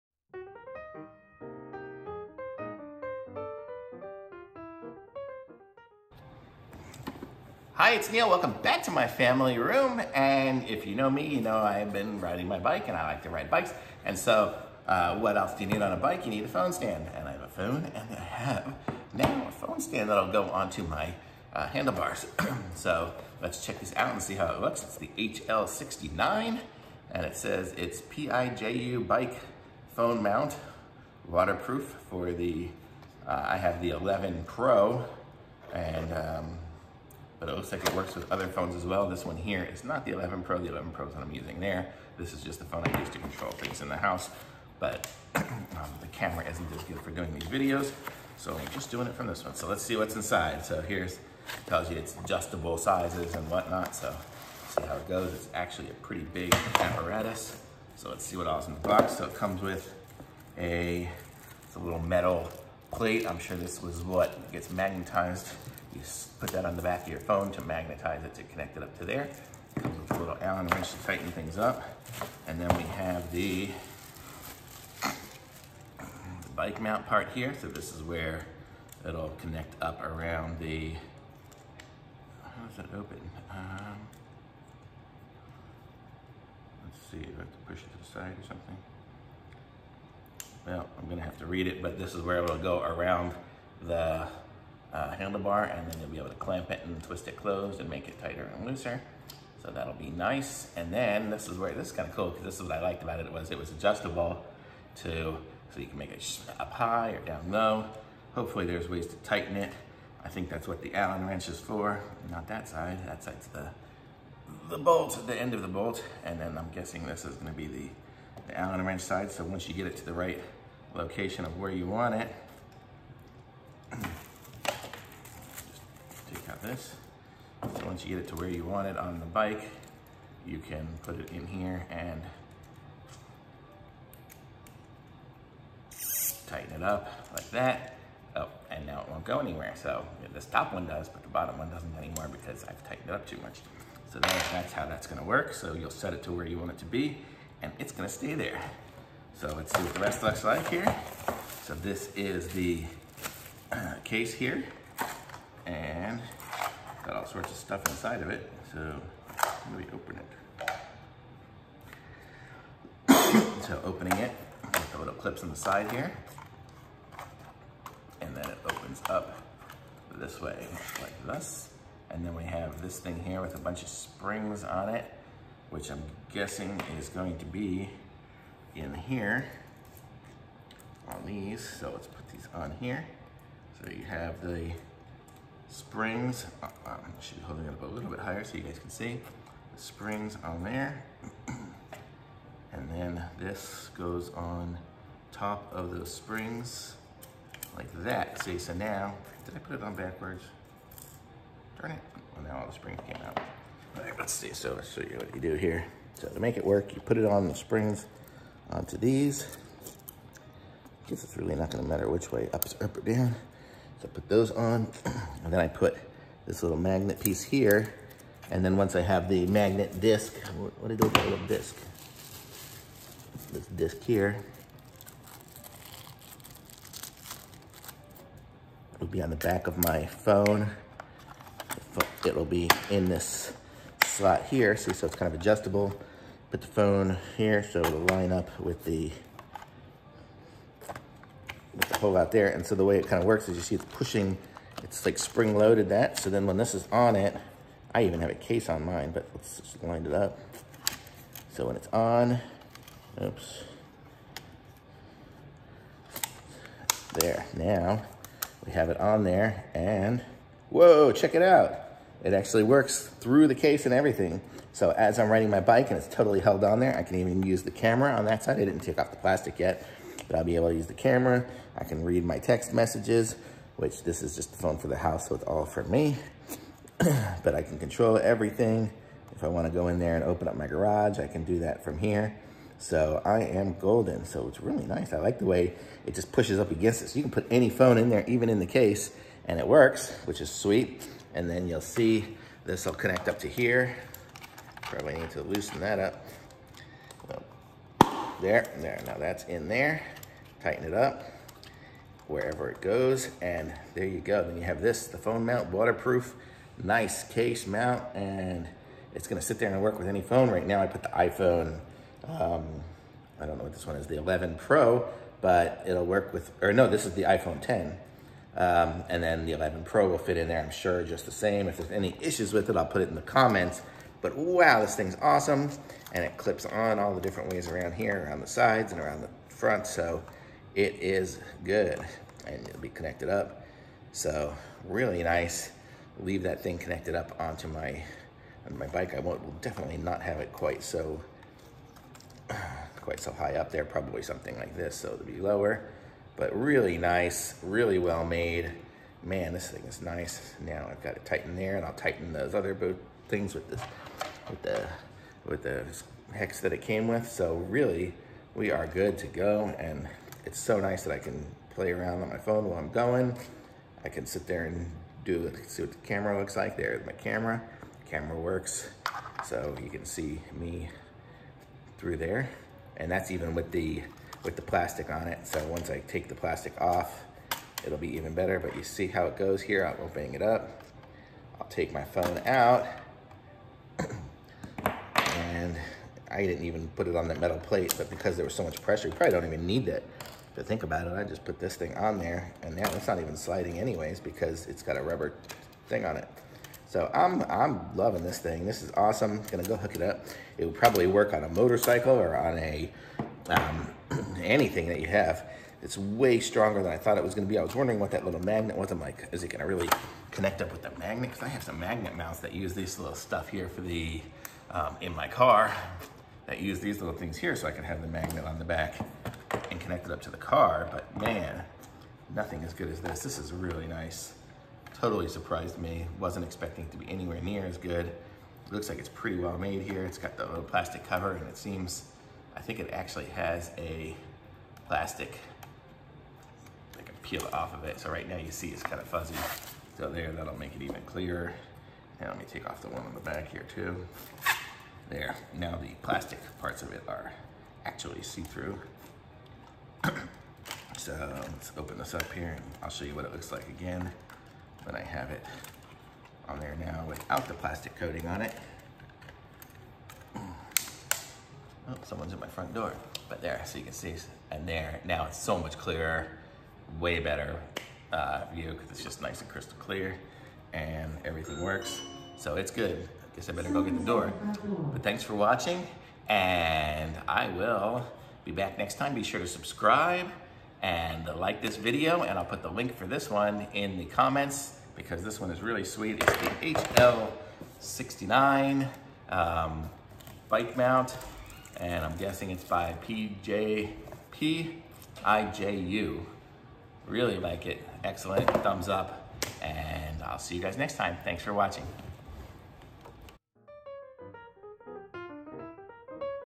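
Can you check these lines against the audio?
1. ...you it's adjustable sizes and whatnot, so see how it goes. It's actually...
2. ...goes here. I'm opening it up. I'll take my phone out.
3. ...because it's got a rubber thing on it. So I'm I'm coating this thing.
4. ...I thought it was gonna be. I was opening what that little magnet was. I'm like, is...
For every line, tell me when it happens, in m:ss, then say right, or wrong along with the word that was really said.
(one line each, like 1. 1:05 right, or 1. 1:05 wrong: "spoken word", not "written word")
1. 0:51 right
2. 6:19 right
3. 6:34 wrong: "loving", not "coating"
4. 6:46 wrong: "wondering", not "opening".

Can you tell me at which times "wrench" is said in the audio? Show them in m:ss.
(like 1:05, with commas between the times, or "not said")
1:10, 1:51, 1:58.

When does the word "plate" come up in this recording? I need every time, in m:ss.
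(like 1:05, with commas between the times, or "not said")
1:02, 6:27.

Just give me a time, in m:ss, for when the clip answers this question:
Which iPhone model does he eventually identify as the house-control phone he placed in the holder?
5:16.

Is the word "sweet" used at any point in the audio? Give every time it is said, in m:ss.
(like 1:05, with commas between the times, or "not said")
4:50, 8:05.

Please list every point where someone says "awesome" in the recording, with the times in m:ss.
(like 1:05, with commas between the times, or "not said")
5:25, 6:38.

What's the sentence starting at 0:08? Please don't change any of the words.
Welcome back to my family room.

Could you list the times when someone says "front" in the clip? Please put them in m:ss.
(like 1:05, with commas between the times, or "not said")
5:29, 7:42.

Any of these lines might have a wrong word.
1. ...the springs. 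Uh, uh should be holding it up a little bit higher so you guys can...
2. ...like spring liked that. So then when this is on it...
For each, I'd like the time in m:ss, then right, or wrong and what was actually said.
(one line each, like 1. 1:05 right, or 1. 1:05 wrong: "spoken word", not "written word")
1. 3:04 right
2. 4:05 wrong: "loaded", not "liked".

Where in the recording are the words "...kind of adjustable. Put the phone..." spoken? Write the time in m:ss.
3:55.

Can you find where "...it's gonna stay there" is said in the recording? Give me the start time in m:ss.
2:27.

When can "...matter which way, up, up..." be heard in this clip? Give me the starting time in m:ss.
3:31.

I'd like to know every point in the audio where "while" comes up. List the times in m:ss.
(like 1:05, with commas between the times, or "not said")
6:02.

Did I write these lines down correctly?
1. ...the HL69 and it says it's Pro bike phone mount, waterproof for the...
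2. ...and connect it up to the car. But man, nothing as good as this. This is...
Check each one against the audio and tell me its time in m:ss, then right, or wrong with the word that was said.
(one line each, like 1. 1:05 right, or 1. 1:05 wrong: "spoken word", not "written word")
1. 0:24 wrong: "PIJU", not "Pro"
2. 6:59 right.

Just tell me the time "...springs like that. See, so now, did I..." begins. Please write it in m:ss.
3:16.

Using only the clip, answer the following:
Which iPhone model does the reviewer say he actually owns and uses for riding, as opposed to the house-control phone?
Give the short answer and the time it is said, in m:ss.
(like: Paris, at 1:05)
11 Pro, at 0:40.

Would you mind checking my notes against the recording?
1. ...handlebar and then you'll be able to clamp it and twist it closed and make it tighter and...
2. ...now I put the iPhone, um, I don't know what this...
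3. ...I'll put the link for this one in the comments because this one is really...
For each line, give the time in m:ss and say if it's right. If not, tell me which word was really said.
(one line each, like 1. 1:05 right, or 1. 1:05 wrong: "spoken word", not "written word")
1. 1:35 right
2. 5:10 right
3. 8:02 right.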